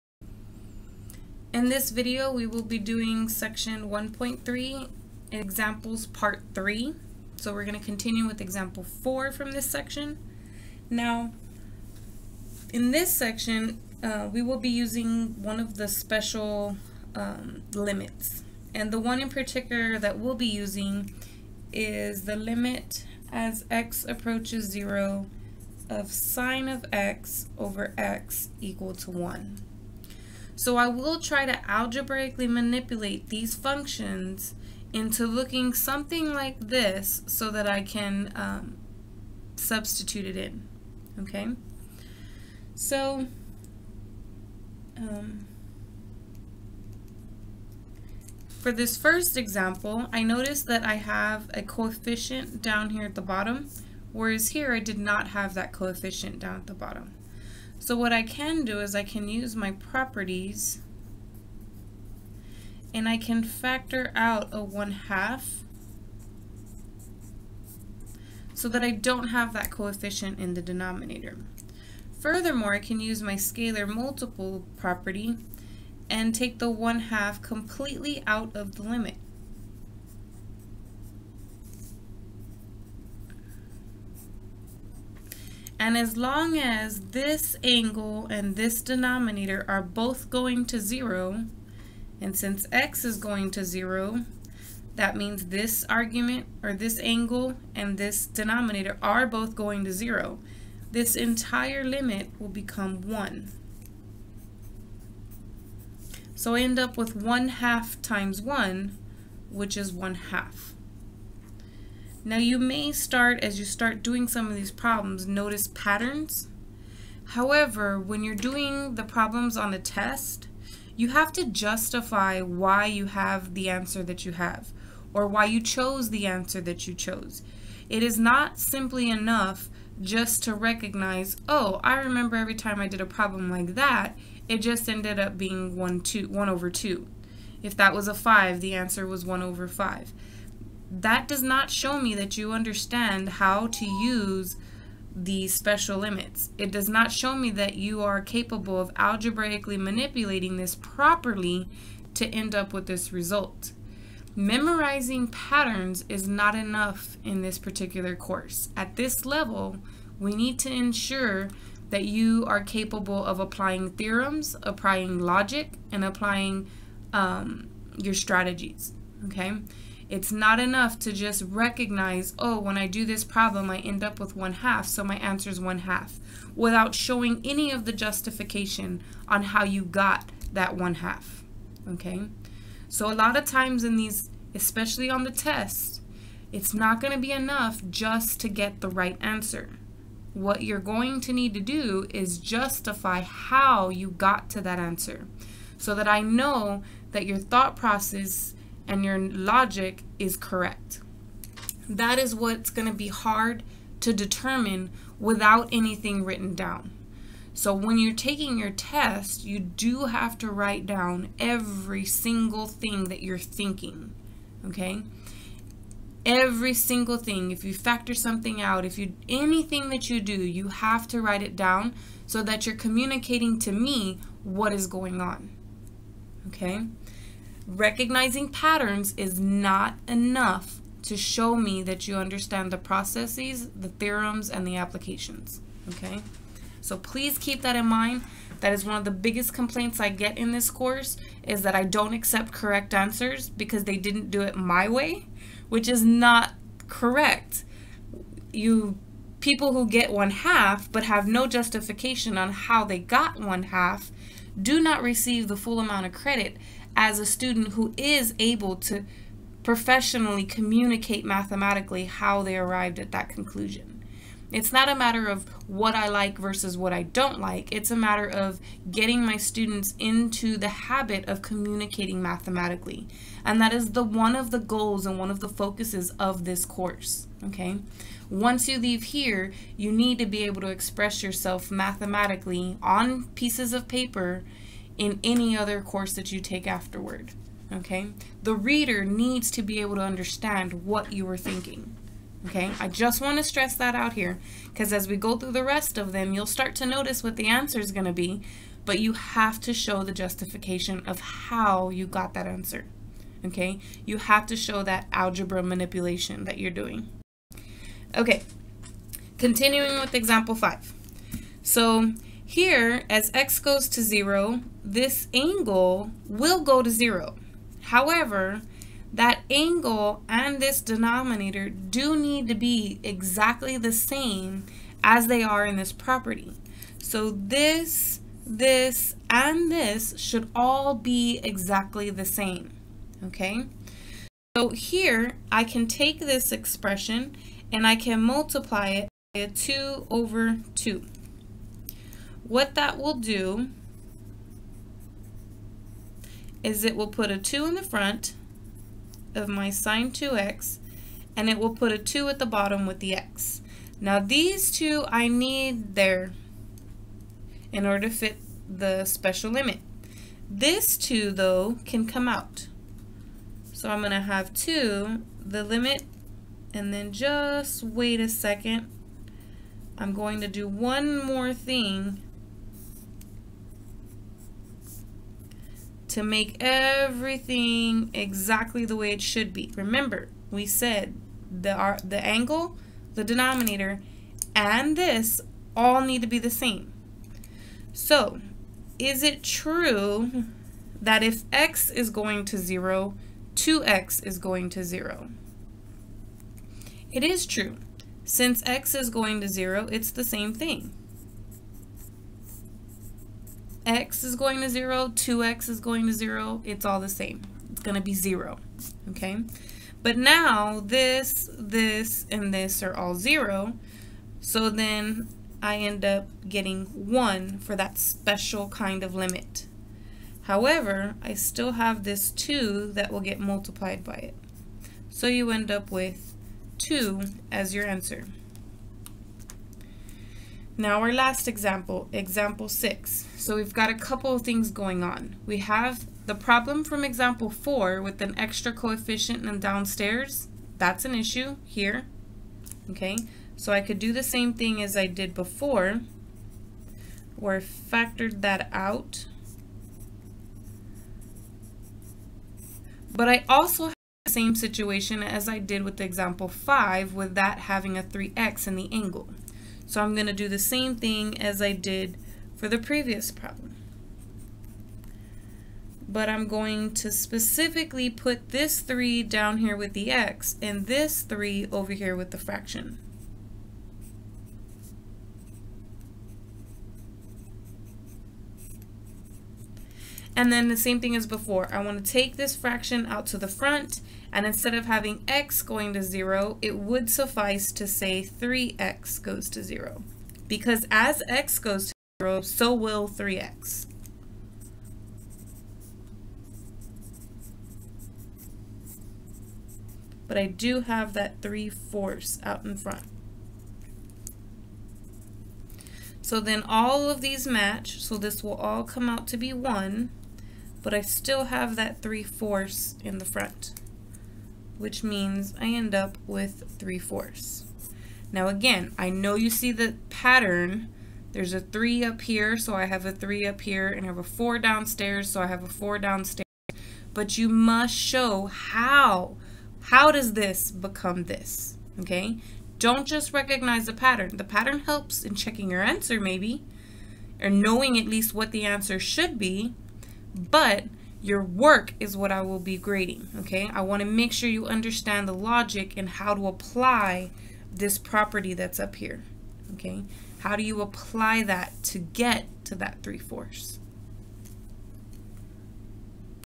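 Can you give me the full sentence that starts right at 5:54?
Now these two I need there in order to fit the special limit.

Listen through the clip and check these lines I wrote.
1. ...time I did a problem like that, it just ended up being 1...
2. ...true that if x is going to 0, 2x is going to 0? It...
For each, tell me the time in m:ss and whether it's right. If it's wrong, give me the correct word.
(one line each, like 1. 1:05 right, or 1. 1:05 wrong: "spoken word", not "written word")
1. 2:12 right
2. 6:29 right.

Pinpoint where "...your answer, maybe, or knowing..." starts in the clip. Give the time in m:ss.
8:55.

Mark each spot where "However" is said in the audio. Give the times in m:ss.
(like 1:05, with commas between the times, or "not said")
1:57, 5:17, 7:00.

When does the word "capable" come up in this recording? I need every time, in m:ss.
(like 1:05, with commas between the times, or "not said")
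2:28, 2:42.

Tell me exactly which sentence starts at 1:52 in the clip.
Now you may start, as you start doing some of these problems, notice patterns.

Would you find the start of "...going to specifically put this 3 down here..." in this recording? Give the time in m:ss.
7:46.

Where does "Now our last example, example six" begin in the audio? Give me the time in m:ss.
7:10.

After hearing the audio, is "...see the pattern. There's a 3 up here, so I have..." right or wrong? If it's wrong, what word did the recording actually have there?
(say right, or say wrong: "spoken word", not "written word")
right.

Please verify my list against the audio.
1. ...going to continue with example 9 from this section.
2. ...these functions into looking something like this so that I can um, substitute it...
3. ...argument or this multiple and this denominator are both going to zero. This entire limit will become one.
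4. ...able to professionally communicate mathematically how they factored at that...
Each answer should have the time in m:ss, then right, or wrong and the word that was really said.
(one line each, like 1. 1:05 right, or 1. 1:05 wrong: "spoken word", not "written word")
1. 0:07 wrong: "4", not "9"
2. 0:33 right
3. 1:35 wrong: "angle", not "multiple"
4. 4:18 wrong: "arrived", not "factored".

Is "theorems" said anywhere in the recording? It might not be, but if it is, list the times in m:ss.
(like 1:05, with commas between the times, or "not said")
2:43, 3:53.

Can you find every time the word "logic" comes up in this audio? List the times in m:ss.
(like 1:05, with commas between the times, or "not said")
2:45, 3:19, 9:05.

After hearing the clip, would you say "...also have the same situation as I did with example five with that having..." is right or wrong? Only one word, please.
right.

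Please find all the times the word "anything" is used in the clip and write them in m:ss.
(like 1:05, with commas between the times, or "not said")
3:25, 3:39.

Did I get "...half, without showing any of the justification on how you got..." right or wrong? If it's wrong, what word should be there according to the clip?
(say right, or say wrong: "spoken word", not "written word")
right.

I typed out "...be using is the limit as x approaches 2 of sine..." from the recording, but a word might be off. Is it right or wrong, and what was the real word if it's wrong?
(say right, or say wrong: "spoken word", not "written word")
wrong: "0", not "2".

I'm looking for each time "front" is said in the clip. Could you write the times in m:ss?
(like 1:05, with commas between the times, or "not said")
5:47, 8:03, 8:22, 8:33.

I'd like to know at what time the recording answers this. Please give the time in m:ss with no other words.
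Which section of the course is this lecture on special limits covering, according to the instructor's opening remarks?
0:03.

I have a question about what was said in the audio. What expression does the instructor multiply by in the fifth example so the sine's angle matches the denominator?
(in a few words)
2/2.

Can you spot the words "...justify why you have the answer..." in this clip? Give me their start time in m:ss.
2:01.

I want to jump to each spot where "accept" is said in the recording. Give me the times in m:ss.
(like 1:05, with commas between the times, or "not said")
4:02.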